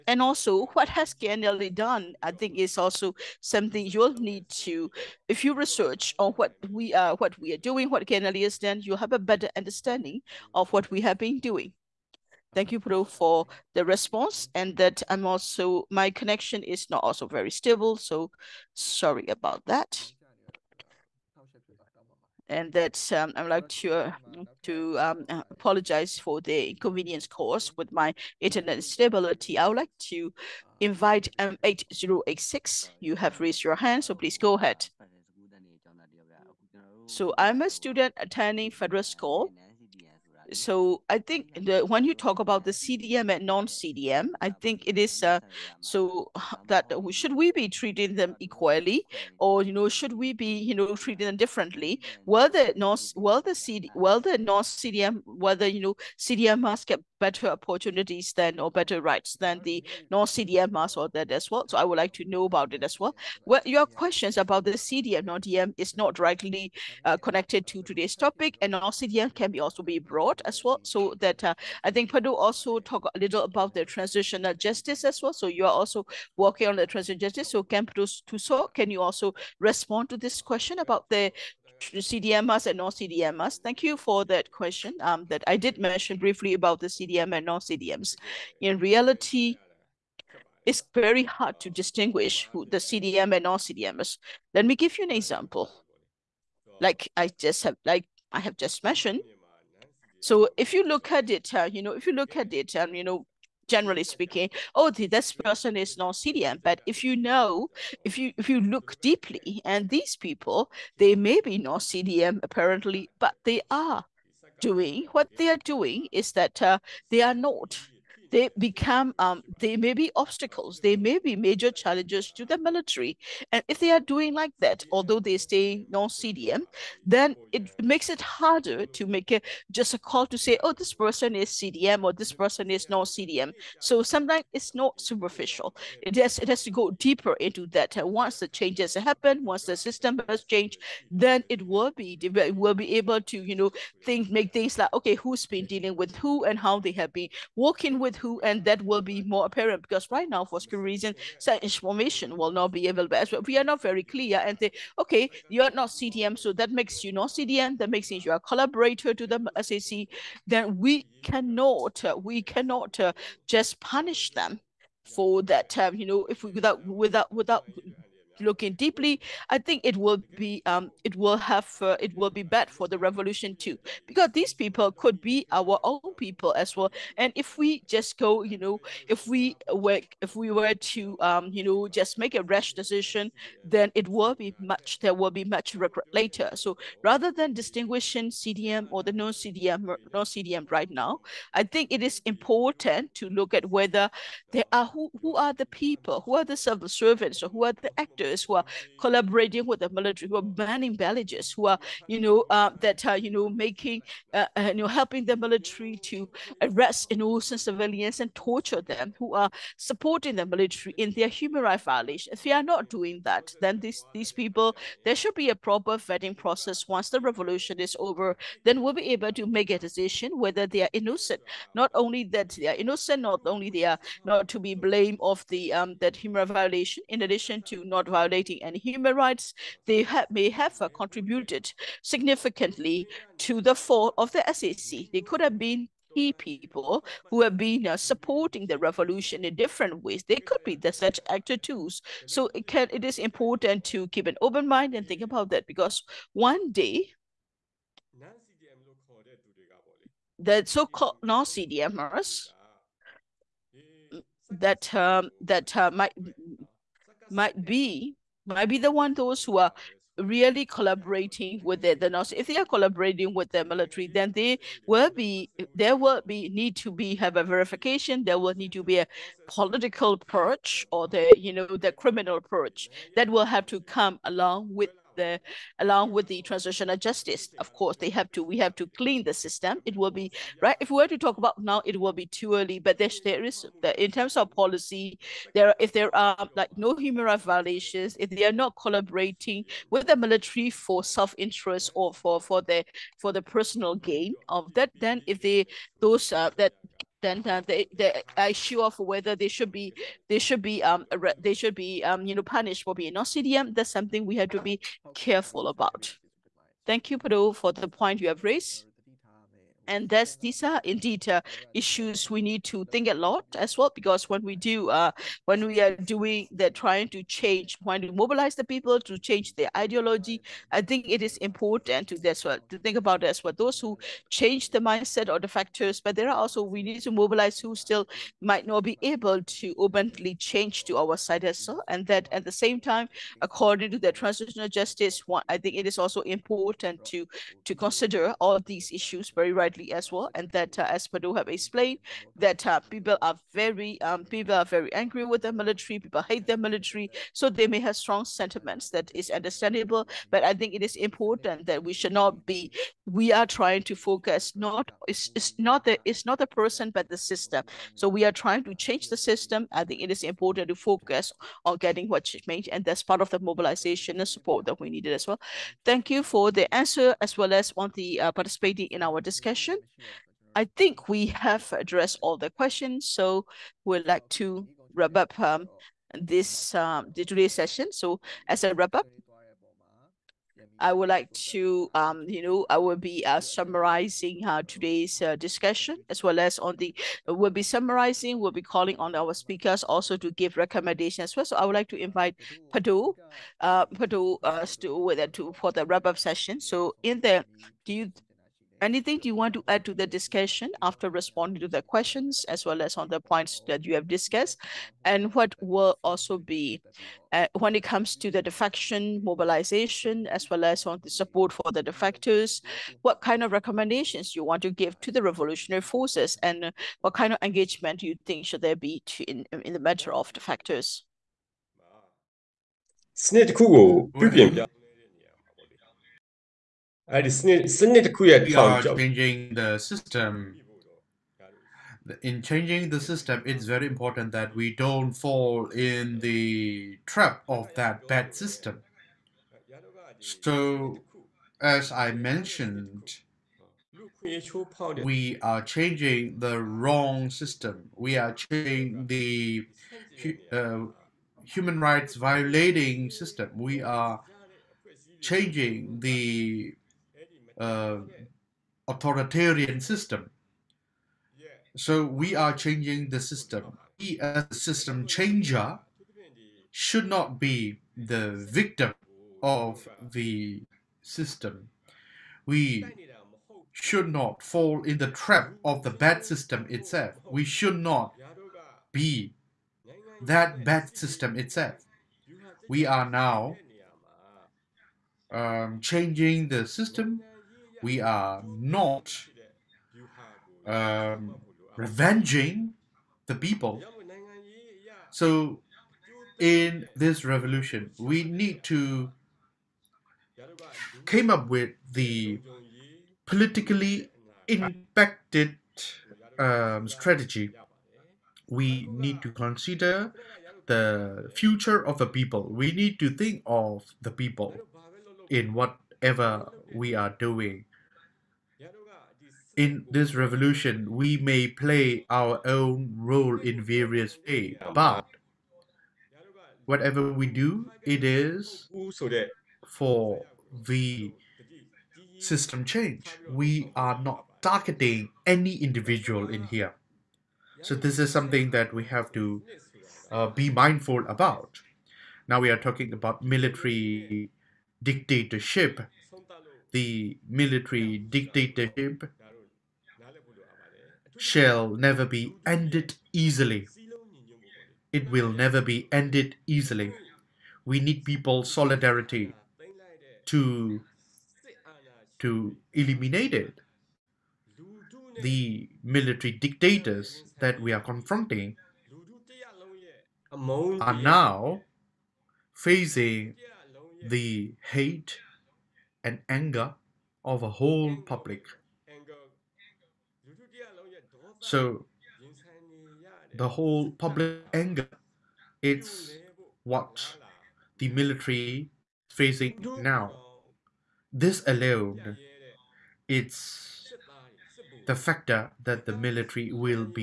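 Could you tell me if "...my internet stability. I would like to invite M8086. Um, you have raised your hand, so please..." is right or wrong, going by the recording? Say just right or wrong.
right.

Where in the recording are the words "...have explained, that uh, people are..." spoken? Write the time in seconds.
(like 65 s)
341 s.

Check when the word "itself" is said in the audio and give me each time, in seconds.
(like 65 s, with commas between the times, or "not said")
476 s, 481 s.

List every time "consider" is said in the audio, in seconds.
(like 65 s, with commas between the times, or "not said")
337 s, 509 s.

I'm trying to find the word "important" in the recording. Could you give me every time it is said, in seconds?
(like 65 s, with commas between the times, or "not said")
192 s, 243 s, 321 s, 336 s, 350 s, 360 s, 433 s.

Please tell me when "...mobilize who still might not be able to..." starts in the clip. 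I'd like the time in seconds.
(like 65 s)
327 s.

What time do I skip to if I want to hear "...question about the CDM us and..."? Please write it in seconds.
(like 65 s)
80 s.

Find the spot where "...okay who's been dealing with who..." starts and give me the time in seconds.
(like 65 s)
144 s.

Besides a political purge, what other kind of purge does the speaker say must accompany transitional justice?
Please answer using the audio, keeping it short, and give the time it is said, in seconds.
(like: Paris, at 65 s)
criminal purge, at 271 s.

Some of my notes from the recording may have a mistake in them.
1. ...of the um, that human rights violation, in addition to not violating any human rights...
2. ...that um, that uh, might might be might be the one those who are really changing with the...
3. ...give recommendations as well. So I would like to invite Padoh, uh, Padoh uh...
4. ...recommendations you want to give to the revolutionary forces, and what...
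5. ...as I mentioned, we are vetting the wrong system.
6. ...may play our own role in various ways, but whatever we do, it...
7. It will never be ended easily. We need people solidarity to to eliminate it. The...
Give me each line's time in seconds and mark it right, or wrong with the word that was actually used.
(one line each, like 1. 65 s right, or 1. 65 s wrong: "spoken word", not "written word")
1. 225 s right
2. 254 s wrong: "collaborating", not "changing"
3. 390 s right
4. 413 s right
5. 441 s wrong: "changing", not "vetting"
6. 521 s right
7. 554 s right.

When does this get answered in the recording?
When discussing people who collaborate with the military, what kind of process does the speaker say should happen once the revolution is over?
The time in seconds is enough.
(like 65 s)
215 s.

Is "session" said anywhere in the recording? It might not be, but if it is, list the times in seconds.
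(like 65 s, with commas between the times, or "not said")
369 s, 377 s, 396 s.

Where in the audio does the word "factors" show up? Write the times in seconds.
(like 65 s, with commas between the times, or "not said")
325 s, 594 s.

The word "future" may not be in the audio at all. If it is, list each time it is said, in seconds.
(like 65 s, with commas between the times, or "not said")
511 s.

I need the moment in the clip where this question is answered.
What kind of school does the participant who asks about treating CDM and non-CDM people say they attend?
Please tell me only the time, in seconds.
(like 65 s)
38 s.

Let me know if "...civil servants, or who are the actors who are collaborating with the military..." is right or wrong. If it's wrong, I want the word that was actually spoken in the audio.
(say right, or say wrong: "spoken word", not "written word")
right.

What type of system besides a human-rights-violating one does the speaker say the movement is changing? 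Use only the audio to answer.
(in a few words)
authoritarian system.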